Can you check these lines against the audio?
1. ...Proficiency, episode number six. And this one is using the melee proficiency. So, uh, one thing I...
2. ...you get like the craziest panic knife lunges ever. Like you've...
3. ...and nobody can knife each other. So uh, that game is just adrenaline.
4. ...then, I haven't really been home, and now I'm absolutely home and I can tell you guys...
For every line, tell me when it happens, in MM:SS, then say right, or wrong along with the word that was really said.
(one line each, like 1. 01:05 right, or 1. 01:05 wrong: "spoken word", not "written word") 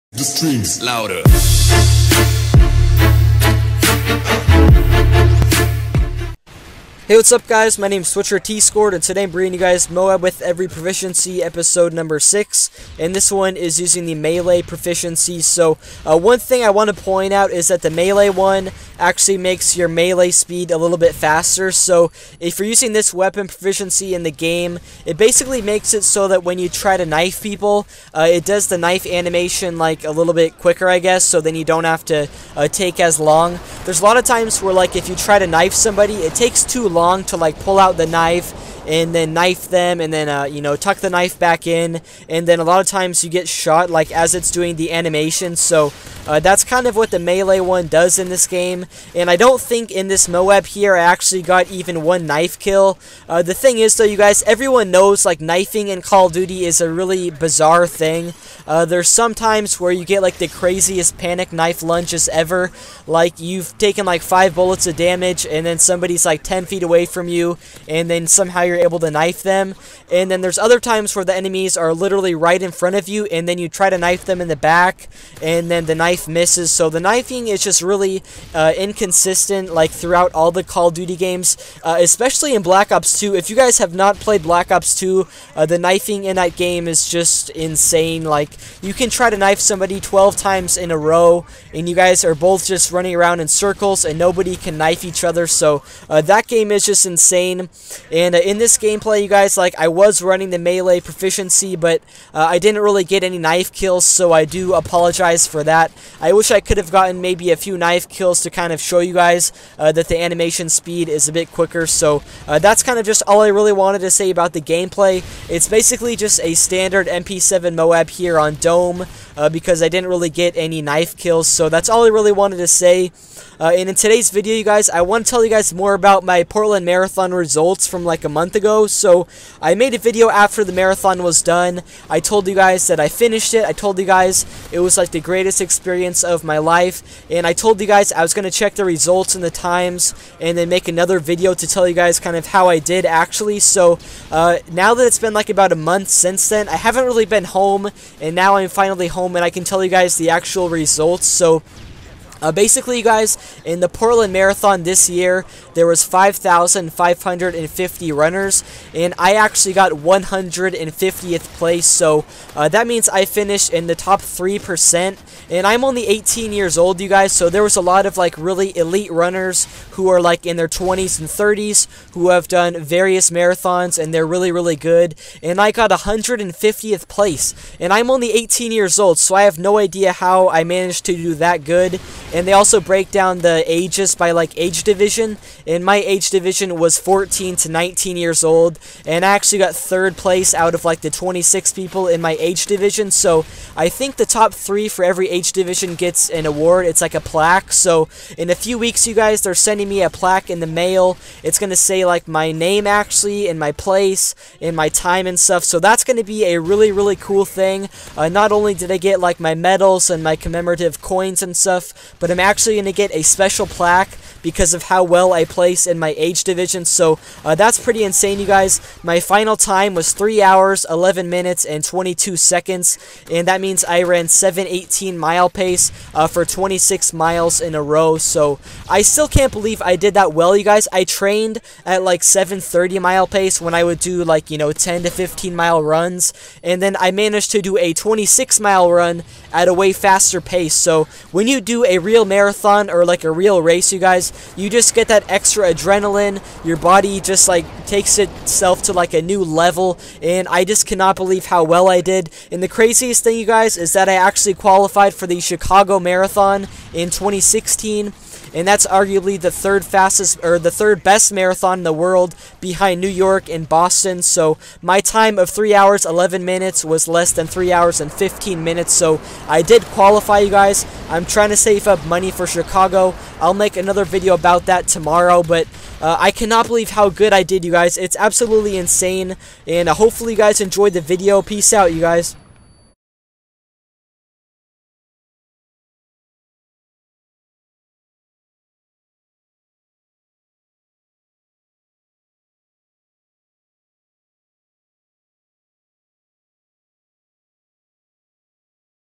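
1. 00:10 right
2. 00:59 right
3. 01:34 wrong: "insane", not "adrenaline"
4. 02:26 wrong: "finally", not "absolutely".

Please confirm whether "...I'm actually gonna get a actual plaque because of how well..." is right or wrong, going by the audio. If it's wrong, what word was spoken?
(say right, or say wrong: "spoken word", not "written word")
wrong: "special", not "actual".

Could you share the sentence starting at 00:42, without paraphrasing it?
And then a lot of times you get shot like as it's doing the animation.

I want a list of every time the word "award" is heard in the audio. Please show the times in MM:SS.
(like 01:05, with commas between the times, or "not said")
03:16.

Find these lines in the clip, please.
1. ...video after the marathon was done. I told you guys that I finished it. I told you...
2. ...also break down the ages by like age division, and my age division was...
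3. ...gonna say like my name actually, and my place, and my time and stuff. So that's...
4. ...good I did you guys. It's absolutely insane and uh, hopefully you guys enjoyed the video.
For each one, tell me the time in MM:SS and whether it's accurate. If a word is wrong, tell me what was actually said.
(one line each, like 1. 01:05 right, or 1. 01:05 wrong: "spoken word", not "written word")
1. 02:09 right
2. 03:02 right
3. 03:21 right
4. 04:37 right.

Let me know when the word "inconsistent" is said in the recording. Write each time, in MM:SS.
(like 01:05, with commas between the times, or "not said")
01:18.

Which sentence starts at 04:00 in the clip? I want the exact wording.
So when you do a real marathon or like like a real race, you guys.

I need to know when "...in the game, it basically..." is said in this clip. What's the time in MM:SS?
00:24.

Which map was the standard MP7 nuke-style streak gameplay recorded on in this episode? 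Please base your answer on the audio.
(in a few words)
Dome.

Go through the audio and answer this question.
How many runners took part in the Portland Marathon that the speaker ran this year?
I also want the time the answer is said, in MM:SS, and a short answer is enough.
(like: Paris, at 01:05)
5,550, at 02:36.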